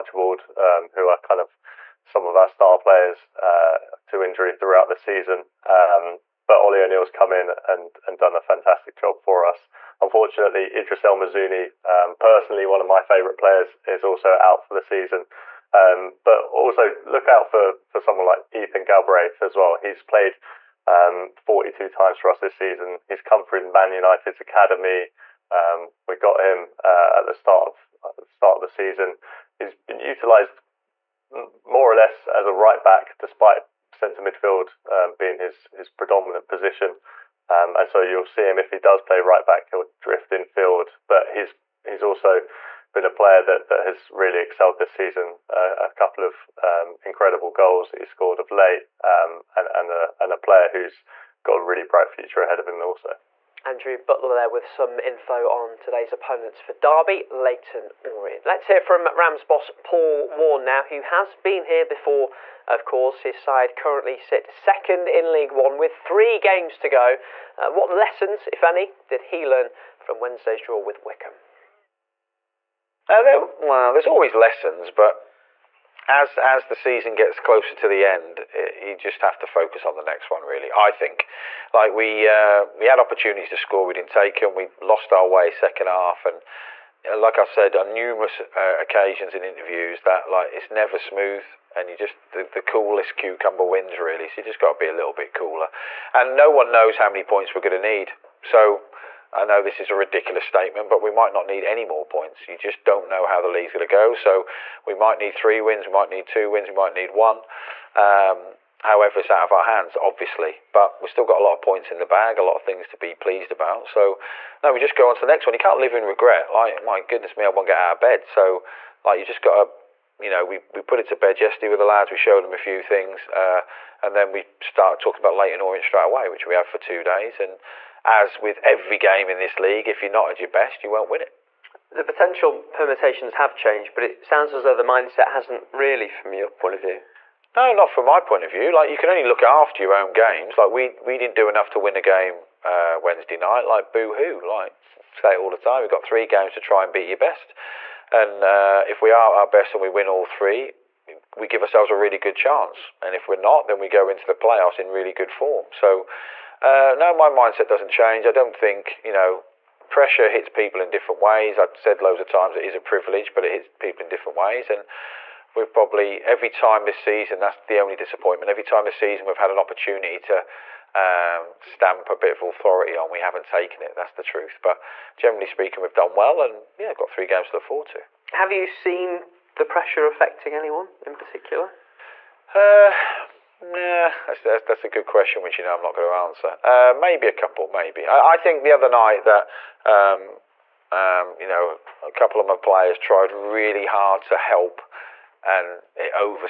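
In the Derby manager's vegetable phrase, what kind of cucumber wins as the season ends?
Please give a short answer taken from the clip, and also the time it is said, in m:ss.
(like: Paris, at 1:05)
The coolest, at 1:32.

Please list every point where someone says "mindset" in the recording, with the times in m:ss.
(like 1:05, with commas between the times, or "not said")
2:14, 2:37.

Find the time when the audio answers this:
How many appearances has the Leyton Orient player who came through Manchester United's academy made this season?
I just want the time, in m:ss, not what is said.
0:21.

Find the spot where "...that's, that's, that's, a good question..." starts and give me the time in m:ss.
3:04.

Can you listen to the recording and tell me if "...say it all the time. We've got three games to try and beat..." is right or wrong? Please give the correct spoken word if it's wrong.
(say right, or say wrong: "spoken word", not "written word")
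right.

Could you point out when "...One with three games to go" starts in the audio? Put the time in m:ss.
1:05.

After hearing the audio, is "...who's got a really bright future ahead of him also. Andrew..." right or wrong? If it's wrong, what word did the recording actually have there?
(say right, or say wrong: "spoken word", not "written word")
right.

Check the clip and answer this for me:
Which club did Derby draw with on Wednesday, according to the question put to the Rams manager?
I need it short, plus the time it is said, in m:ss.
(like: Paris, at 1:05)
Wycombe, at 1:11.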